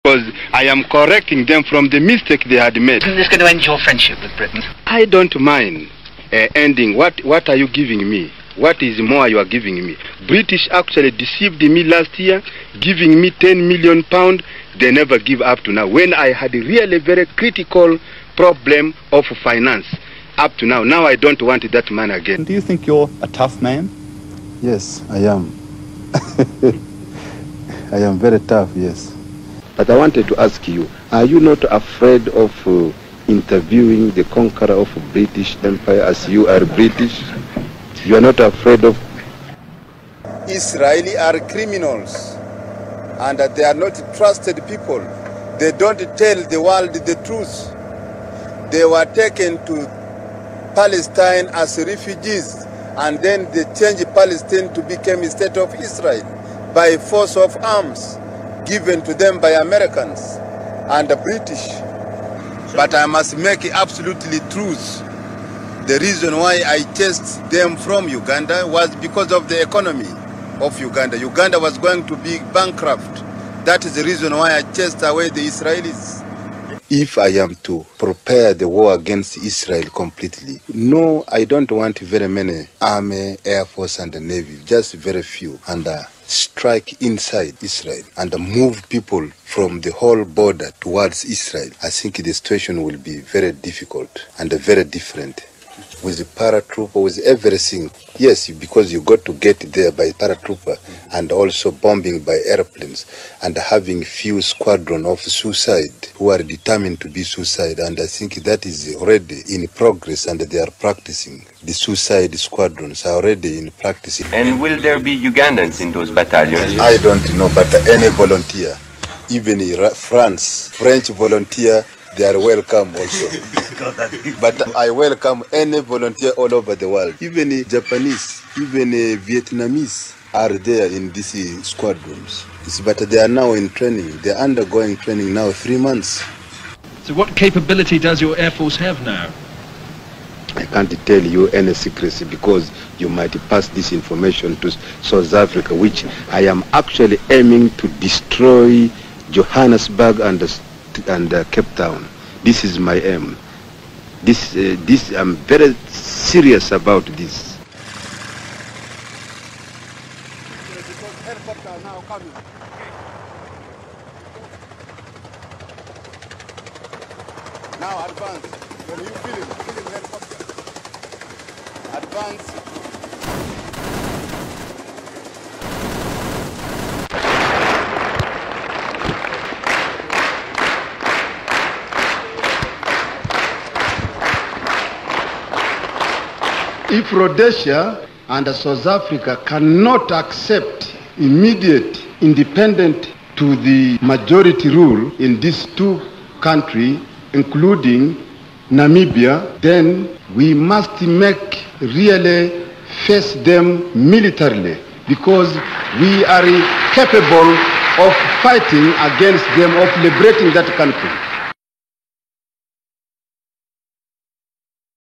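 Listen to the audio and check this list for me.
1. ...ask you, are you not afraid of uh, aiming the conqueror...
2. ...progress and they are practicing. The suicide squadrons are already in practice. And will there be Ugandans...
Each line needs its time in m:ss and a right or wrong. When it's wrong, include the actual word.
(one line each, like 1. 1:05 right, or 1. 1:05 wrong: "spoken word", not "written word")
1. 0:30 wrong: "interviewing", not "aiming"
2. 1:49 right.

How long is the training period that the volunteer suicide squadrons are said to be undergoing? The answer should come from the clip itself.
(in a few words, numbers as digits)
three months.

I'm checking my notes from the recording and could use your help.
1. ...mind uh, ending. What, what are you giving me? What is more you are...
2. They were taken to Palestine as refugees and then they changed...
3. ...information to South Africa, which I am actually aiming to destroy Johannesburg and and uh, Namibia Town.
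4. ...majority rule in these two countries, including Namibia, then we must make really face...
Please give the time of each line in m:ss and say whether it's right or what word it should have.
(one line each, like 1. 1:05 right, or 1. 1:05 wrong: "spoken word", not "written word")
1. 0:05 right
2. 0:48 right
3. 2:23 wrong: "Cape", not "Namibia"
4. 3:14 right.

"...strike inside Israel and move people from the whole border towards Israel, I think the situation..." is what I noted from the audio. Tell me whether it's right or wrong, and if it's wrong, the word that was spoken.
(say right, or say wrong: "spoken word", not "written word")
right.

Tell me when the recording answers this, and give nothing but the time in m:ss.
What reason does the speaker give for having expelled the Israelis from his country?
1:09.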